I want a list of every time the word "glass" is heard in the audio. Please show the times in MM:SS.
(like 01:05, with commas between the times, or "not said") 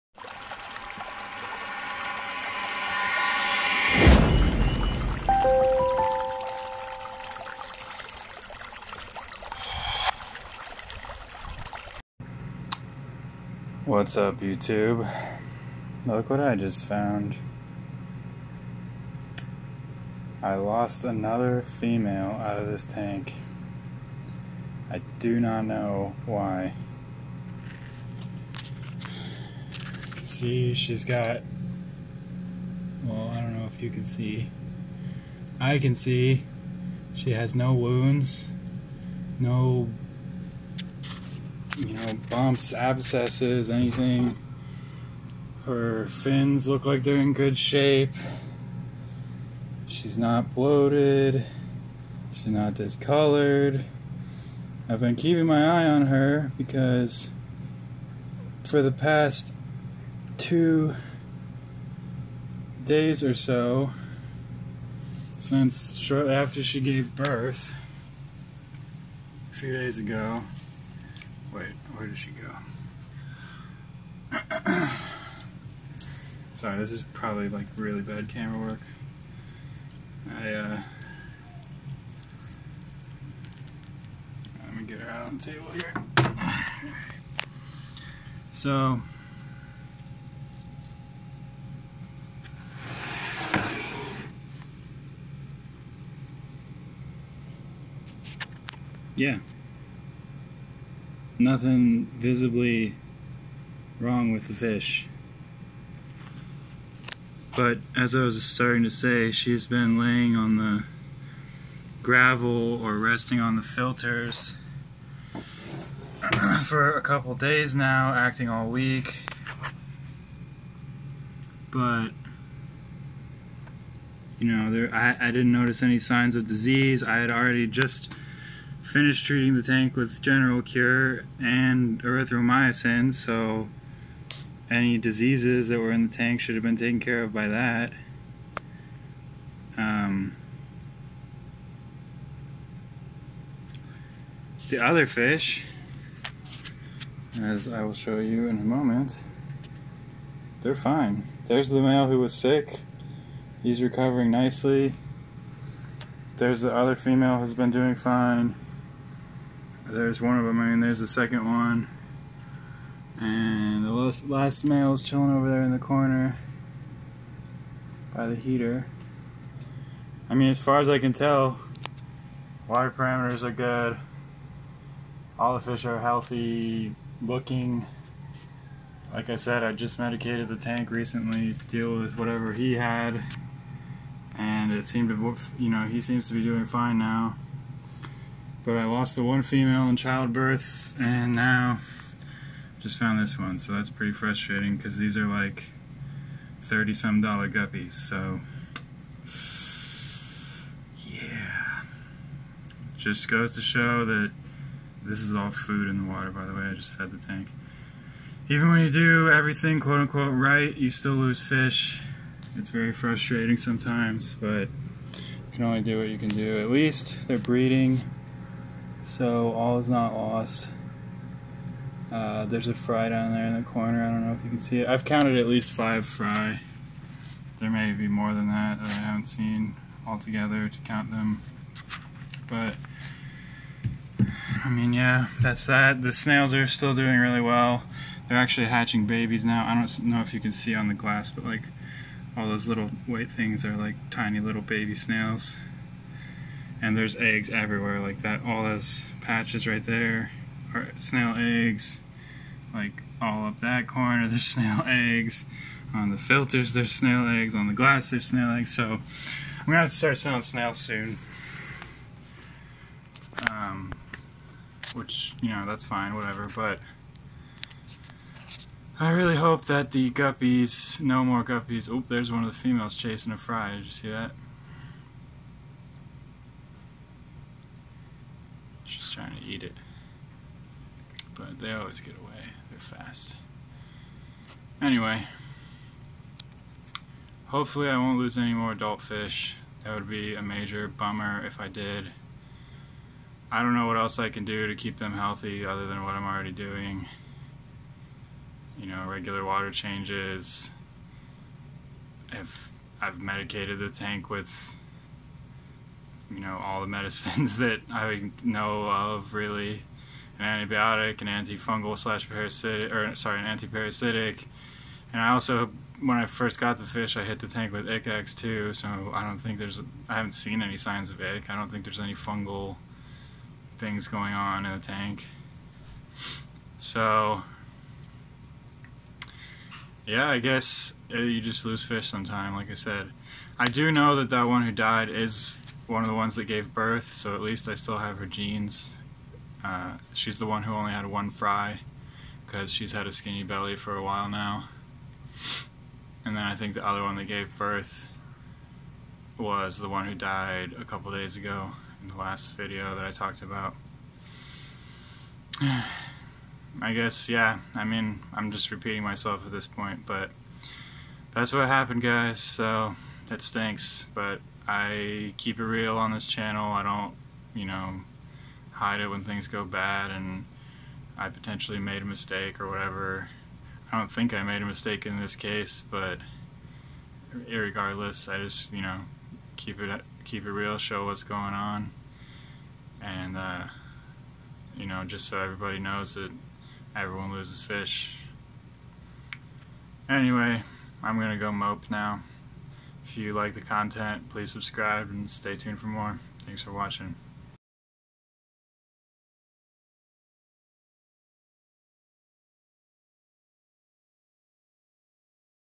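04:00, 04:17.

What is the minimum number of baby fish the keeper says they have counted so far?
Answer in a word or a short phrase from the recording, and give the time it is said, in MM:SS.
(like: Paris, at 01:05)
5, at 03:45.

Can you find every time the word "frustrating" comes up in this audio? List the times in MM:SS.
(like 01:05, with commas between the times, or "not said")
03:14, 03:32.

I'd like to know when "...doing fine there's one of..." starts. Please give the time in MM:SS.
02:37.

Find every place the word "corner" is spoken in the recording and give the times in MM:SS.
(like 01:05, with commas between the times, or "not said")
02:45, 03:43, 04:13.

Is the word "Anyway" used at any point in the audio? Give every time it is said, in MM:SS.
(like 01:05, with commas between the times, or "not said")
04:44, 06:30.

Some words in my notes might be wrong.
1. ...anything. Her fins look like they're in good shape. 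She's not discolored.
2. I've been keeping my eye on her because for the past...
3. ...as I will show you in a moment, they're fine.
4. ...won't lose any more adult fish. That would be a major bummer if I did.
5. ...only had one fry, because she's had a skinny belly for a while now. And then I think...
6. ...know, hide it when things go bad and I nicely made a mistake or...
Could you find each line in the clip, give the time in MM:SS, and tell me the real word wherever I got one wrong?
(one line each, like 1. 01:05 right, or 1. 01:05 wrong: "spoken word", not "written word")
1. 00:43 wrong: "bloated", not "discolored"
2. 00:54 right
3. 02:27 right
4. 04:47 right
5. 05:40 right
6. 06:07 wrong: "potentially", not "nicely".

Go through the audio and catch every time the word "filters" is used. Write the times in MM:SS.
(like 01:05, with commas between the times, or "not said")
01:53, 04:16.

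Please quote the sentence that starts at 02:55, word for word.
All the fish are healthy looking.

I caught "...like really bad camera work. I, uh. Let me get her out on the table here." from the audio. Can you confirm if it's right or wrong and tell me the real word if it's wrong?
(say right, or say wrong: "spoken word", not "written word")
right.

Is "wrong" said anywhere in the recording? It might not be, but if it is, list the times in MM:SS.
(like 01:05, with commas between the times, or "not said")
01:43.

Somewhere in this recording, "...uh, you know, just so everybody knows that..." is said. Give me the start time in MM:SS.
06:23.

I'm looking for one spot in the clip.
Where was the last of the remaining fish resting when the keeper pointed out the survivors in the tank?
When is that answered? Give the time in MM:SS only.
02:48.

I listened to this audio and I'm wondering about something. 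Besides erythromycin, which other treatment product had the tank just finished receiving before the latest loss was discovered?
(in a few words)
General Cure.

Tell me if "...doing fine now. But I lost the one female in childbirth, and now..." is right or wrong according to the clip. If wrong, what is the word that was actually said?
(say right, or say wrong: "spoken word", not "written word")
right.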